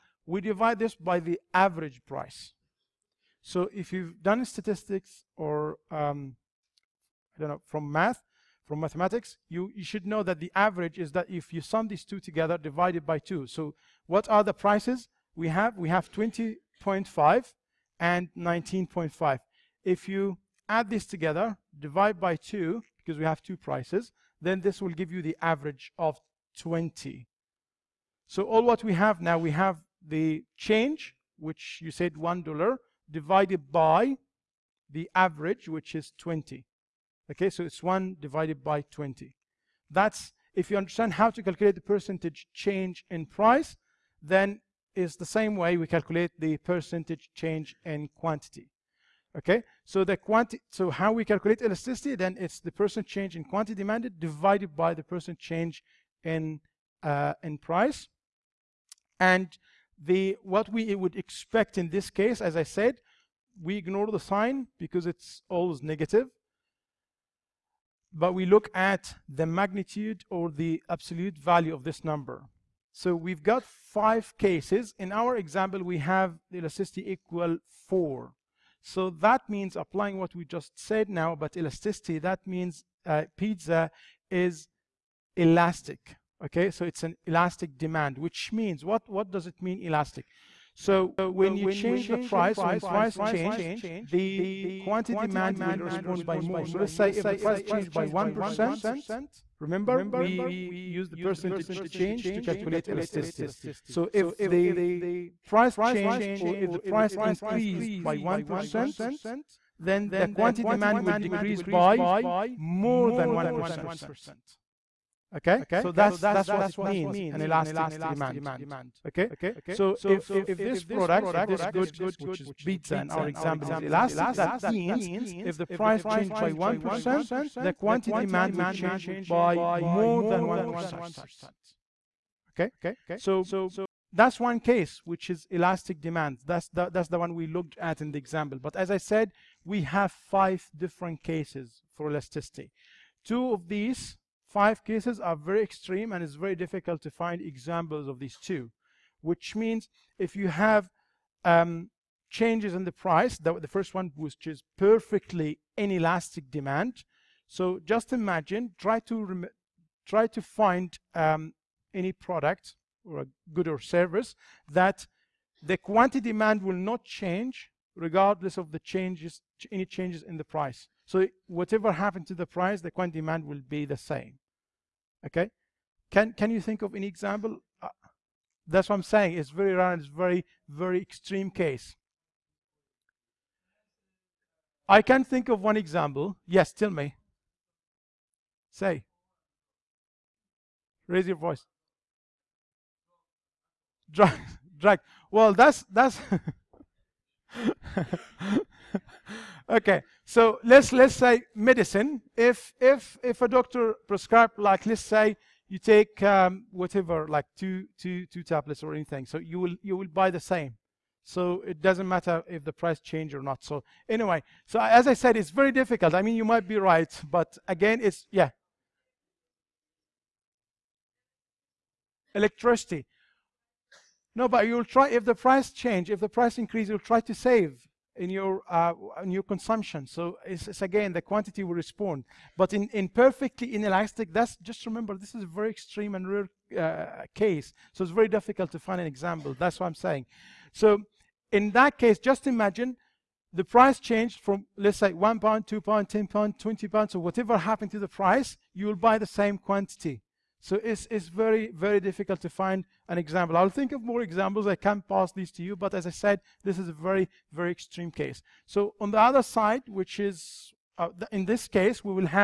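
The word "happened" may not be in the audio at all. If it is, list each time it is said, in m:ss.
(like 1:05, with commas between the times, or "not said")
2:51, 4:07.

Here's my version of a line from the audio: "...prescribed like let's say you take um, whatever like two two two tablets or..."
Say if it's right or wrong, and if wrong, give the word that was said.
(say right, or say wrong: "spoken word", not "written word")
right.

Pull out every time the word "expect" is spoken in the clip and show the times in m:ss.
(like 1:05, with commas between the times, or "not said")
1:01.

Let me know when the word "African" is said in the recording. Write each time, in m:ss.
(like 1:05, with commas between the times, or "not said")
not said.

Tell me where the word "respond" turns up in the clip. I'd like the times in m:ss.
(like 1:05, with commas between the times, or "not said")
1:35, 3:51.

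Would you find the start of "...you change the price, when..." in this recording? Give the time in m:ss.
1:31.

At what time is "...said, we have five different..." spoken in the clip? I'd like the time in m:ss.
2:18.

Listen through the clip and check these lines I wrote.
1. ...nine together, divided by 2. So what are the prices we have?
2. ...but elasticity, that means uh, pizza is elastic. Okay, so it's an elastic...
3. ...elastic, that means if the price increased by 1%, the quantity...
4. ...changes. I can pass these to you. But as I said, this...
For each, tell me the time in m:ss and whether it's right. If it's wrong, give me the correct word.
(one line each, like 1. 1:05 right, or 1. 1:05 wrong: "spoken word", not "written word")
1. 0:12 wrong: "two", not "nine"
2. 1:21 right
3. 2:03 wrong: "changed", not "increased"
4. 4:14 wrong: "examples", not "changes".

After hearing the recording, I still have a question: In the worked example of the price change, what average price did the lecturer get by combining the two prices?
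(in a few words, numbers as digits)
20.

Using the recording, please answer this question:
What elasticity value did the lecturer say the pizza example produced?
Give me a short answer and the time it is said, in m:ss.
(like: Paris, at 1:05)
4, at 1:16.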